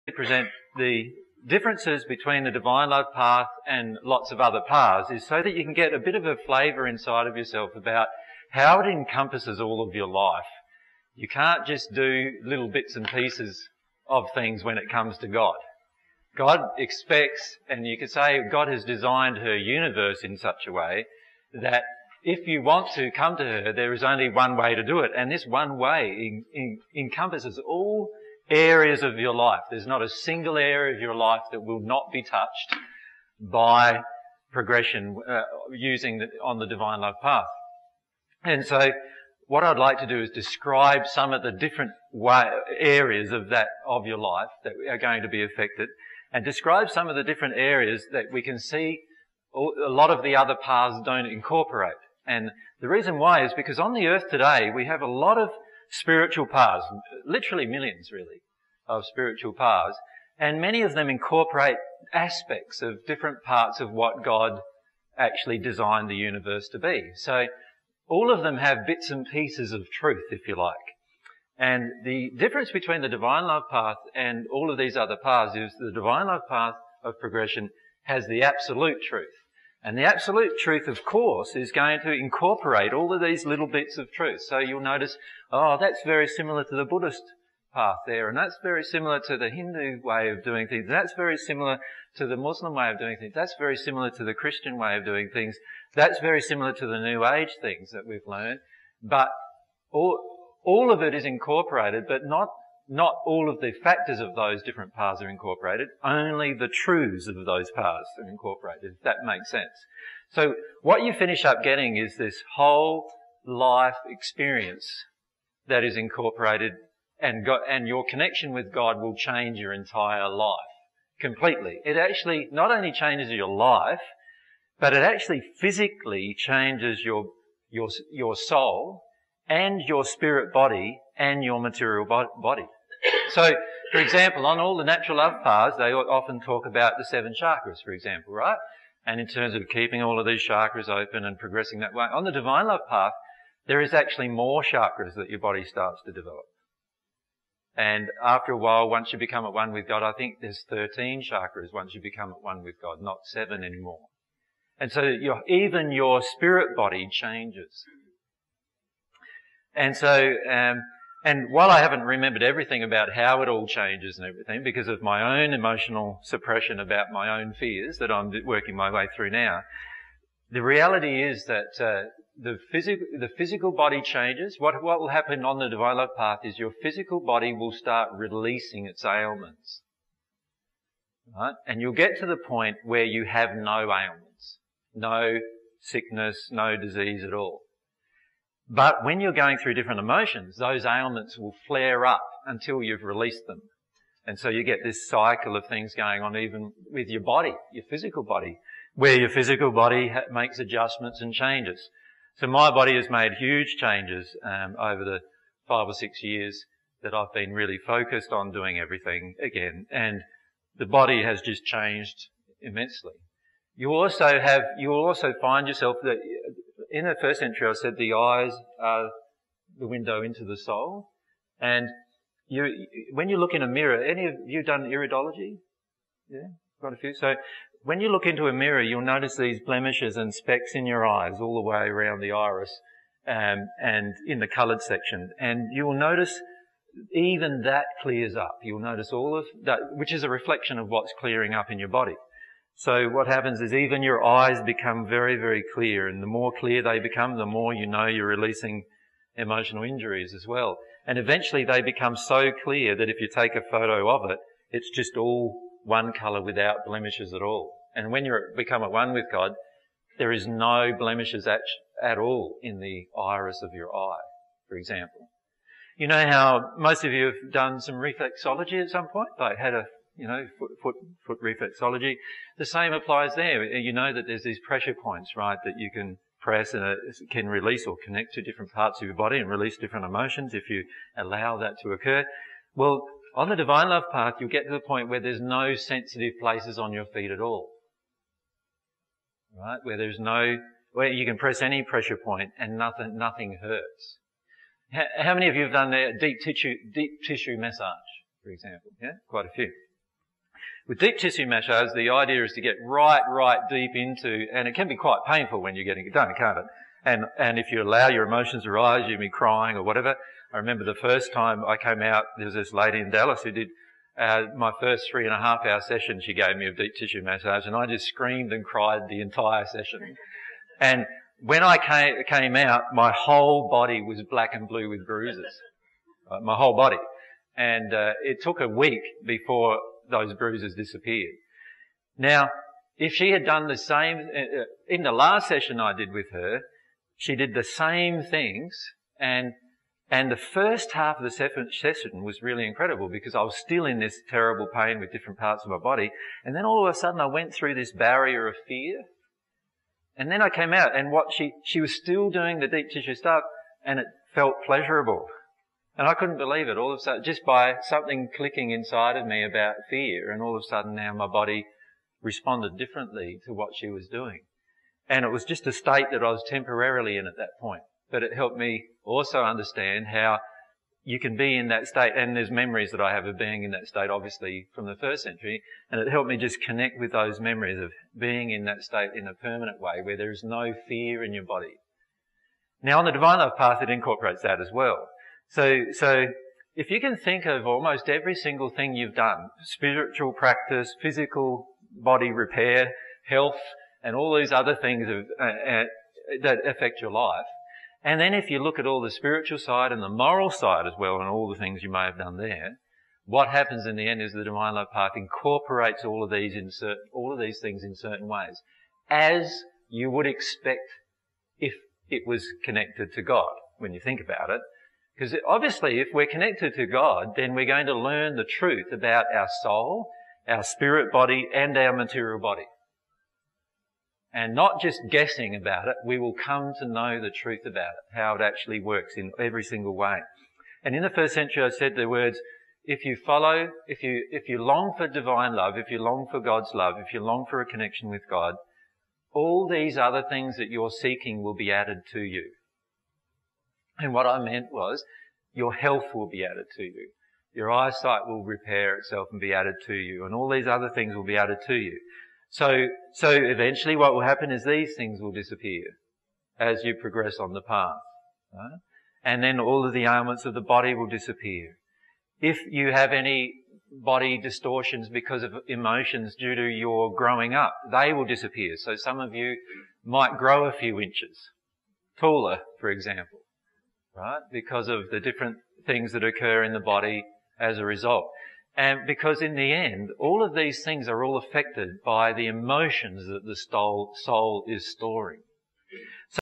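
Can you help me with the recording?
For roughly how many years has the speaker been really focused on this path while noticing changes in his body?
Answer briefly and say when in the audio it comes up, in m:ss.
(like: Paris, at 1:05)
5 or 6 years, at 3:25.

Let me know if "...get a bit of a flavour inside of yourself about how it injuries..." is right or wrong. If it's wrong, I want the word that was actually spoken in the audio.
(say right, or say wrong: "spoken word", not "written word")
wrong: "encompasses", not "injuries".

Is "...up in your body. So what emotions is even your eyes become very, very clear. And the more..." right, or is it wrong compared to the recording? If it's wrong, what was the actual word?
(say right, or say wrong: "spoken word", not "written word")
wrong: "happens", not "emotions".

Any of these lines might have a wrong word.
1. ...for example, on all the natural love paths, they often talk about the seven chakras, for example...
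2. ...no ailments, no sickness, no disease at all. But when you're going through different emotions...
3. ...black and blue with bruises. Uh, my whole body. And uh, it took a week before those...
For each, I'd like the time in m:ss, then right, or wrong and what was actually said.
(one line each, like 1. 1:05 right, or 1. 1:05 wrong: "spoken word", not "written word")
1. 2:13 right
2. 3:03 right
3. 5:24 right.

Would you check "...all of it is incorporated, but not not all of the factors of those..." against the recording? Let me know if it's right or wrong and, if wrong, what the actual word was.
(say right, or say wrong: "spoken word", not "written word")
right.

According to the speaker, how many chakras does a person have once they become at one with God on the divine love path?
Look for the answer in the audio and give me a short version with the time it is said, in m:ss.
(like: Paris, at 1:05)
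13, at 2:30.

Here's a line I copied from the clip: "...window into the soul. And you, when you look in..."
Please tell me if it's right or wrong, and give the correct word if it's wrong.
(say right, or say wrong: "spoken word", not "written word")
right.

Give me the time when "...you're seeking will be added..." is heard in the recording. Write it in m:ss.
7:20.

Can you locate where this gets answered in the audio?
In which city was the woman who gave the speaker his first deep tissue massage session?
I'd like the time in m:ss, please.
5:13.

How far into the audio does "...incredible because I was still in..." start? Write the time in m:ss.
5:42.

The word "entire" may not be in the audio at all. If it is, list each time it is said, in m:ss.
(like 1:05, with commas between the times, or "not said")
1:59, 5:19.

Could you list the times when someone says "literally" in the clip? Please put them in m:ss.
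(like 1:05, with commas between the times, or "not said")
0:57.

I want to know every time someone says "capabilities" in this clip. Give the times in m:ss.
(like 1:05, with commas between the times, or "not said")
not said.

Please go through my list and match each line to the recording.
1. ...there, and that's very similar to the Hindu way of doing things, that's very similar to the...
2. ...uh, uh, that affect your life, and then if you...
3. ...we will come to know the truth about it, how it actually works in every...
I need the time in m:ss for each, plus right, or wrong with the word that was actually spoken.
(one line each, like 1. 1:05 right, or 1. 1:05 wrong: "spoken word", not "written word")
1. 1:28 right
2. 6:35 right
3. 7:06 right.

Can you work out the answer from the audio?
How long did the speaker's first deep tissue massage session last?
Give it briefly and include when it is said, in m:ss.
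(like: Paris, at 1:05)
3.5 hours, at 5:15.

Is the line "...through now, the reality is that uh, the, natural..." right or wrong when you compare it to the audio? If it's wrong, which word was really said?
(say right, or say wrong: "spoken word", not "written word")
wrong: "physical", not "natural".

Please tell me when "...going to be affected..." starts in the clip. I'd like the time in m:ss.
0:44.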